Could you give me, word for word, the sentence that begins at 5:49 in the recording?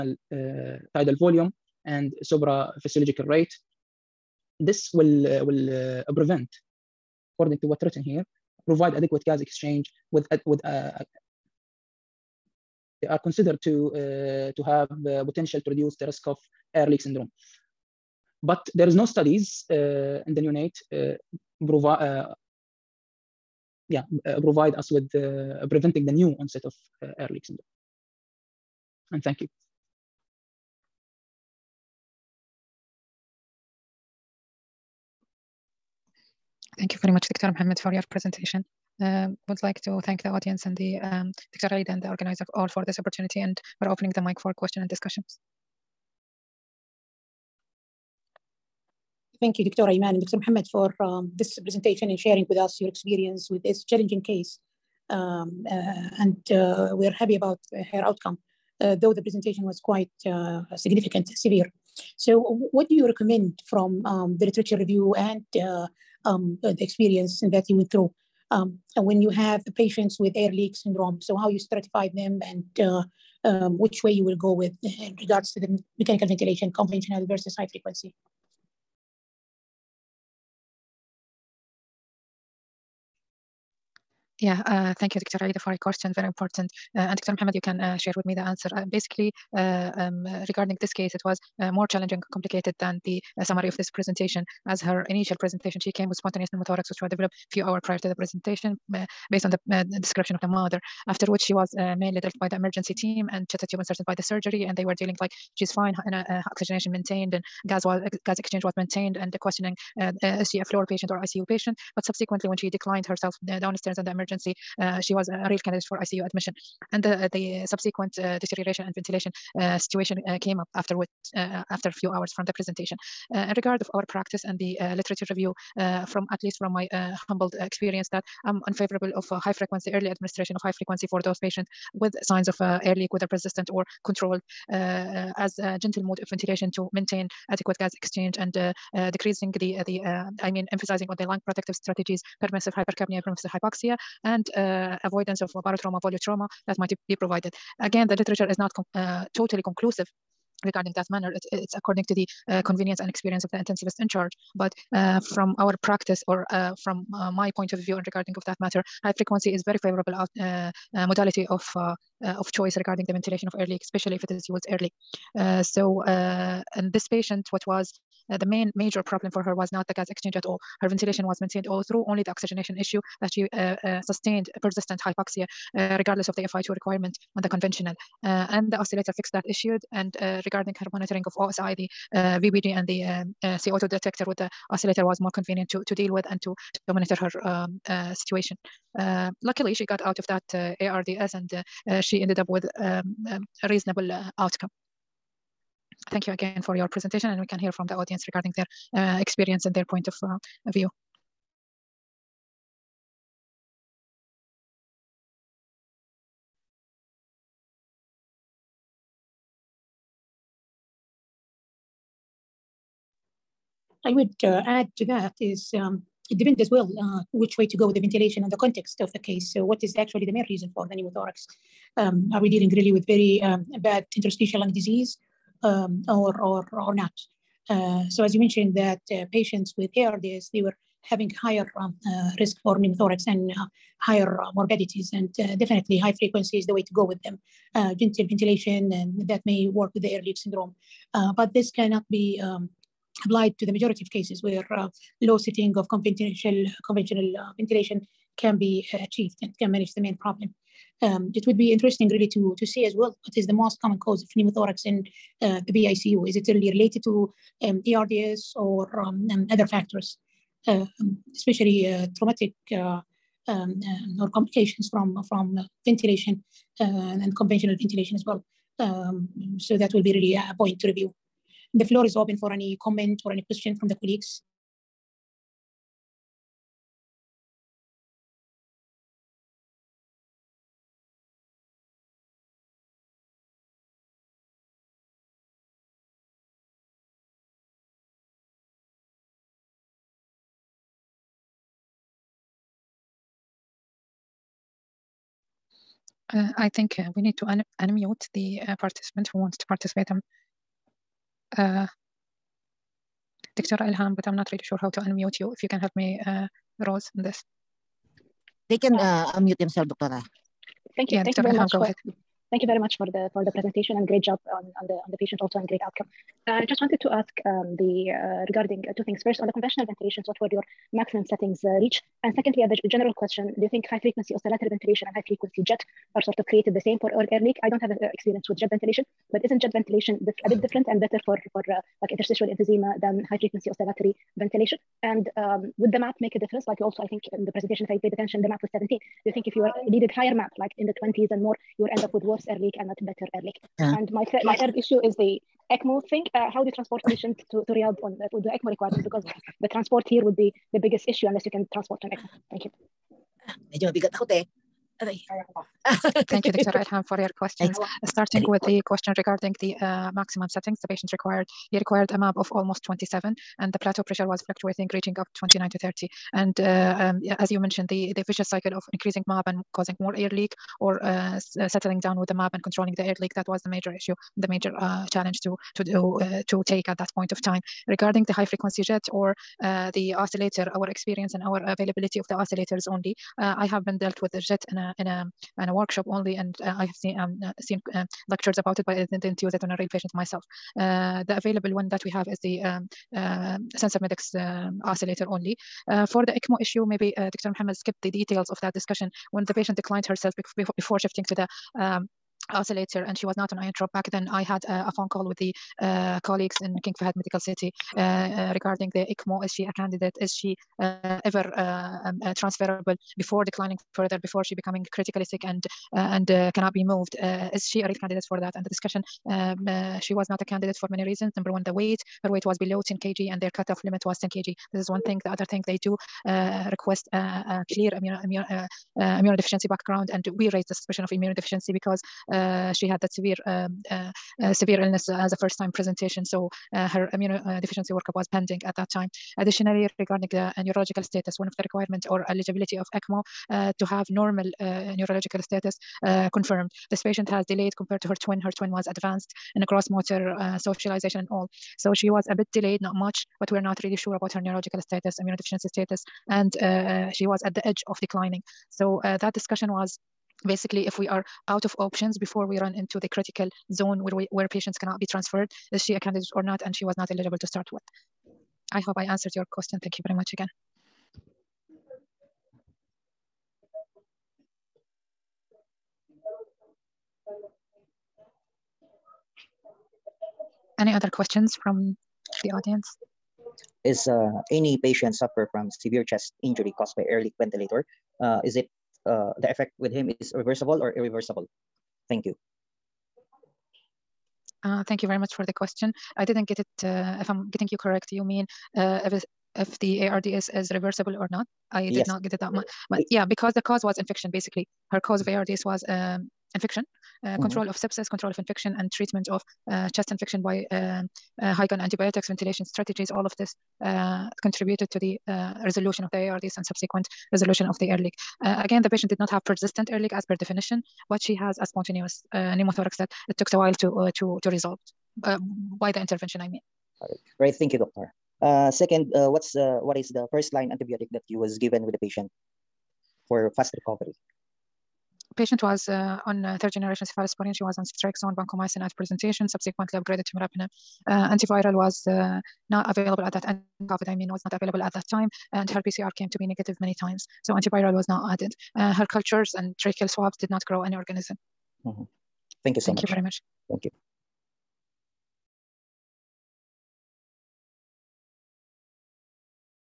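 Because the transport here would be the biggest issue unless you can transport an ECMO.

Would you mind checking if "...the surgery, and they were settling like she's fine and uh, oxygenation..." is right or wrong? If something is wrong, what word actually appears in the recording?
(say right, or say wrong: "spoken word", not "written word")
wrong: "dealing", not "settling".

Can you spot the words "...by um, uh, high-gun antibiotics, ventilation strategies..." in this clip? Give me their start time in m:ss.
8:30.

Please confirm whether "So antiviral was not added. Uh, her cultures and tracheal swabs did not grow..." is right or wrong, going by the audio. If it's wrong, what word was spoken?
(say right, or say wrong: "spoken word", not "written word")
right.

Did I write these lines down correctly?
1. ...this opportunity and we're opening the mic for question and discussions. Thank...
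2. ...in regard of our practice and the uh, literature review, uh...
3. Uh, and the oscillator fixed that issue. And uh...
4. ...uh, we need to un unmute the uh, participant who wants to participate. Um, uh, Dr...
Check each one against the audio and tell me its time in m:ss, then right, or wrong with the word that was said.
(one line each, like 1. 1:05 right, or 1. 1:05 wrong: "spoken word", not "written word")
1. 0:42 right
2. 2:03 right
3. 2:58 right
4. 4:56 right.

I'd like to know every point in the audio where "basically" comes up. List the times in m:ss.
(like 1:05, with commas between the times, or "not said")
1:28, 7:40, 8:24.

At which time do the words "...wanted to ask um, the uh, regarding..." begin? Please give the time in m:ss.
5:16.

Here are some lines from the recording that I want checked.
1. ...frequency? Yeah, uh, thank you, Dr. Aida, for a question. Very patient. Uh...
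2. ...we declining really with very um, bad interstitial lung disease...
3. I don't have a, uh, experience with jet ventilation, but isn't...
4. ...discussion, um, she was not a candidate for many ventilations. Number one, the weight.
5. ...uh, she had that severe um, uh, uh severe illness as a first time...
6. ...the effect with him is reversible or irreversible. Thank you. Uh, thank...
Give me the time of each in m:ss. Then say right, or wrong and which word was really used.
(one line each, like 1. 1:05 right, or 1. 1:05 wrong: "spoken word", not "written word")
1. 1:17 wrong: "important", not "patient"
2. 3:42 wrong: "dealing", not "declining"
3. 5:27 right
4. 6:58 wrong: "reasons", not "ventilations"
5. 7:12 right
6. 8:09 right.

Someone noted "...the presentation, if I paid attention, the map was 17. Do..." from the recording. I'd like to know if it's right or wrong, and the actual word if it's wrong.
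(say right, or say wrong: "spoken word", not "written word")
right.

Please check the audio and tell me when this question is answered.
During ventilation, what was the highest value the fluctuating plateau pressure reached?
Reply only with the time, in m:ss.
6:05.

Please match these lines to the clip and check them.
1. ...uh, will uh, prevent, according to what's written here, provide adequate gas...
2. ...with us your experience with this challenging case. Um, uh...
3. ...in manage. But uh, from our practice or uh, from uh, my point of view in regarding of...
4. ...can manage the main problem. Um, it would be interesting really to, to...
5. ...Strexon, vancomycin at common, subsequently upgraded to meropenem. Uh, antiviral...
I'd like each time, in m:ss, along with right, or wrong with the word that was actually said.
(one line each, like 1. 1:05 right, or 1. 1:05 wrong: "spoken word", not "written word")
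1. 0:05 right
2. 0:52 right
3. 2:33 wrong: "charge", not "manage"
4. 4:09 right
5. 8:57 wrong: "presentation", not "common".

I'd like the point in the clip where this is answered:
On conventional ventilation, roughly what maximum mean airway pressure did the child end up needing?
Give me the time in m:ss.
6:02.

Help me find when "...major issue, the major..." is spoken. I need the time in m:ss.
6:13.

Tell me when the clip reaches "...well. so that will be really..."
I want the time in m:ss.
4:28.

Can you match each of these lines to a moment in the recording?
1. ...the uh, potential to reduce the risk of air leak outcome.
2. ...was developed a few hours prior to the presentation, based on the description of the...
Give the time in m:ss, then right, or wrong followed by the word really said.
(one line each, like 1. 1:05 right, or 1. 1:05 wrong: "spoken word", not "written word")
1. 0:15 wrong: "syndrome", not "outcome"
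2. 1:37 right.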